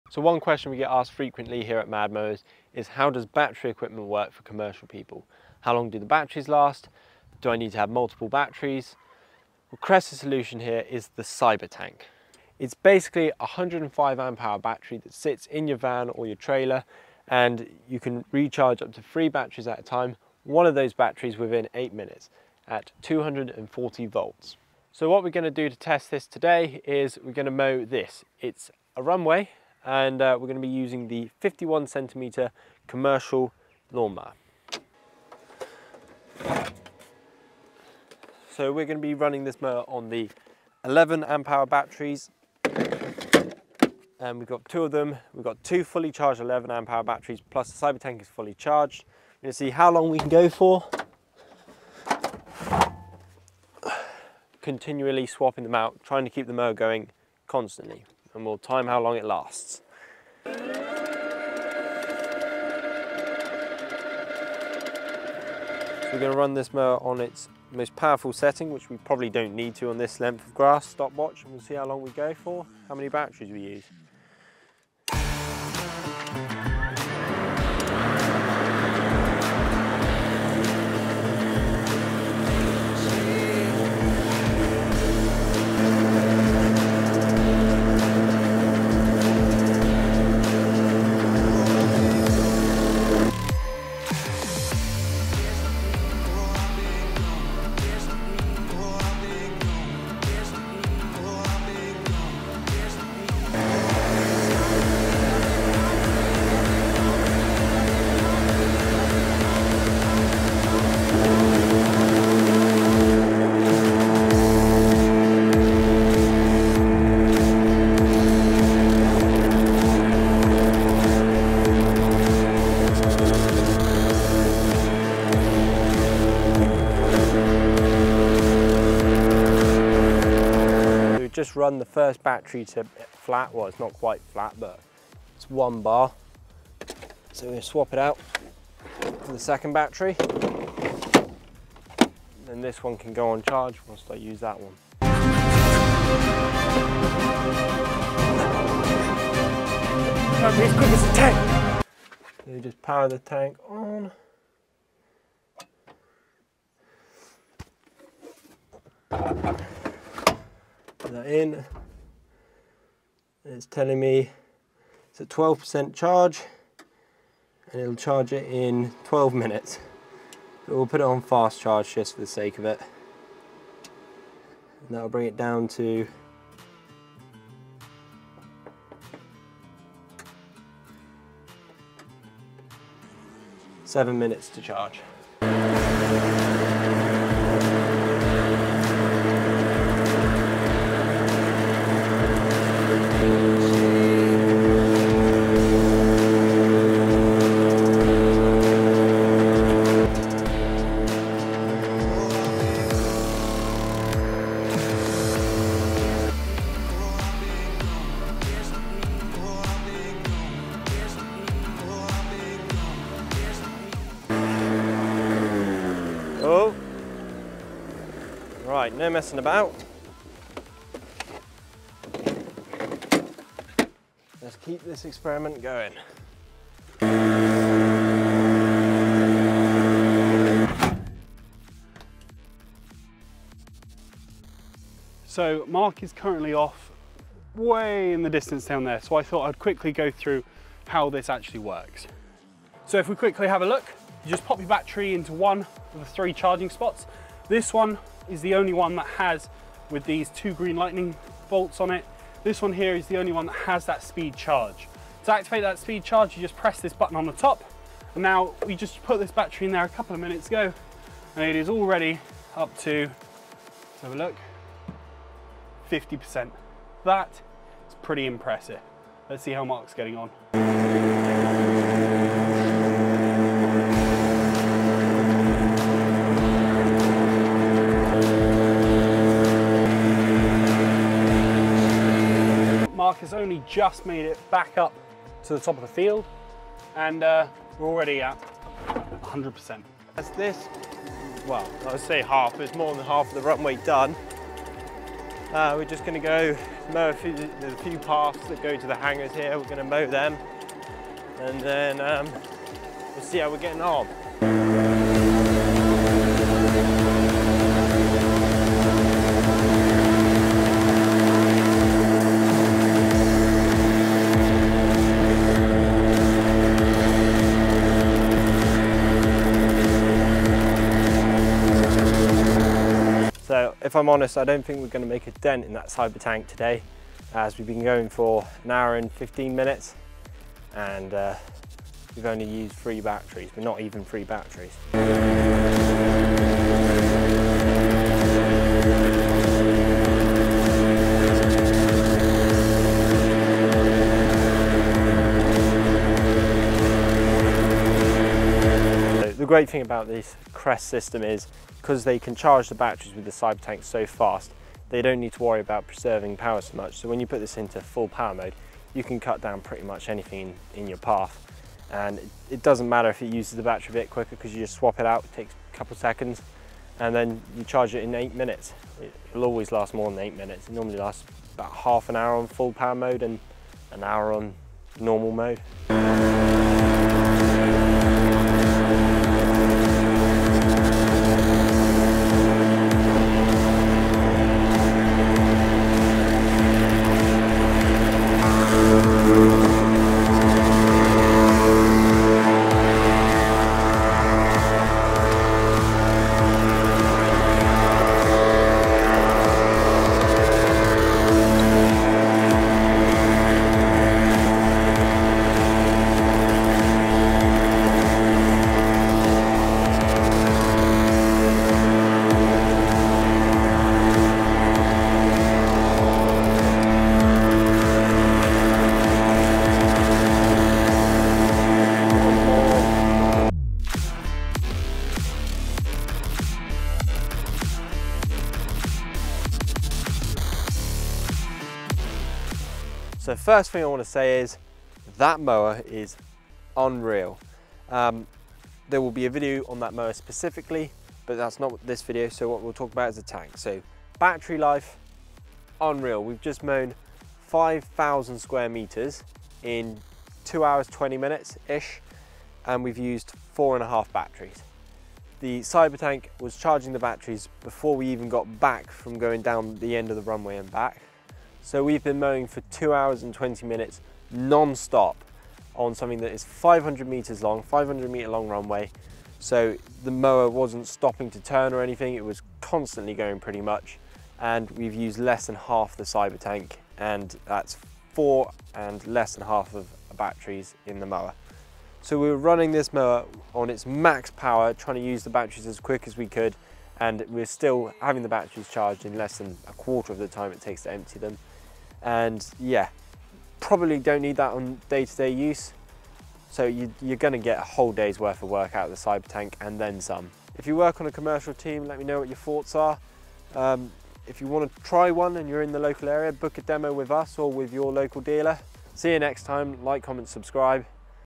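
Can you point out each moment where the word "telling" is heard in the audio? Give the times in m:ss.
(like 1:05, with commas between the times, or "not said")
2:43.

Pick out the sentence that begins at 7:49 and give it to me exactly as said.
So the mower wasn't stopping to turn or anything.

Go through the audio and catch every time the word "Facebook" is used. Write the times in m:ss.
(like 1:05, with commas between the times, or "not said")
not said.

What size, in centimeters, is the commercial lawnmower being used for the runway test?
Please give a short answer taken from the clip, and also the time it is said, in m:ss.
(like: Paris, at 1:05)
51, at 0:31.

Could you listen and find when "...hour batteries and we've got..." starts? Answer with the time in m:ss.
0:41.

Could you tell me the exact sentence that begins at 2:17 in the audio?
So we're gonna swap it out for the second battery.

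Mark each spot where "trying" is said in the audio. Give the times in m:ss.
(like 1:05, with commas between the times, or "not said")
0:56, 8:04.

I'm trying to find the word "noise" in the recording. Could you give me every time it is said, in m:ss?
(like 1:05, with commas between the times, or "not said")
not said.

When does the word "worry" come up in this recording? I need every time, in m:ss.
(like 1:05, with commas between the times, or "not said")
5:55.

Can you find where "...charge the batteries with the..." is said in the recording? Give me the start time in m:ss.
5:52.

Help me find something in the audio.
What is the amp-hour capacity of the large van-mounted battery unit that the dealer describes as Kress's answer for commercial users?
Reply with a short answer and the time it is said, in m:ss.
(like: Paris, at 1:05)
105, at 0:13.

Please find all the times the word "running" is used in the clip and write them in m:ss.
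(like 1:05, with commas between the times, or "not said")
0:39, 8:02.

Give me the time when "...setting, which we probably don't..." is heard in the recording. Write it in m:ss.
1:08.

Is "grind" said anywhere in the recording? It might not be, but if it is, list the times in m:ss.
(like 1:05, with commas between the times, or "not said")
not said.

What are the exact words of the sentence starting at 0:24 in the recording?
So what we're gonna do to test this today is we're gonna mow this.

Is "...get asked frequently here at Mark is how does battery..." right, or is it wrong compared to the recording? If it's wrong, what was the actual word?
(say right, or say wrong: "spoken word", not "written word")
wrong: "MadMowers", not "Mark".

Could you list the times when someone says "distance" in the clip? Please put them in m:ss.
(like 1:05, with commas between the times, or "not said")
3:58.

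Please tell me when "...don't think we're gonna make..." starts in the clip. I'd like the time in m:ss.
5:24.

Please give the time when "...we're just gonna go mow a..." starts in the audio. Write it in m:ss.
4:55.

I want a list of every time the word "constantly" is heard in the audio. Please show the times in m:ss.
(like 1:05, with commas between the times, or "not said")
0:57, 7:52.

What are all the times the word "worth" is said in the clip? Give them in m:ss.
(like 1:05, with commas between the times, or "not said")
8:18.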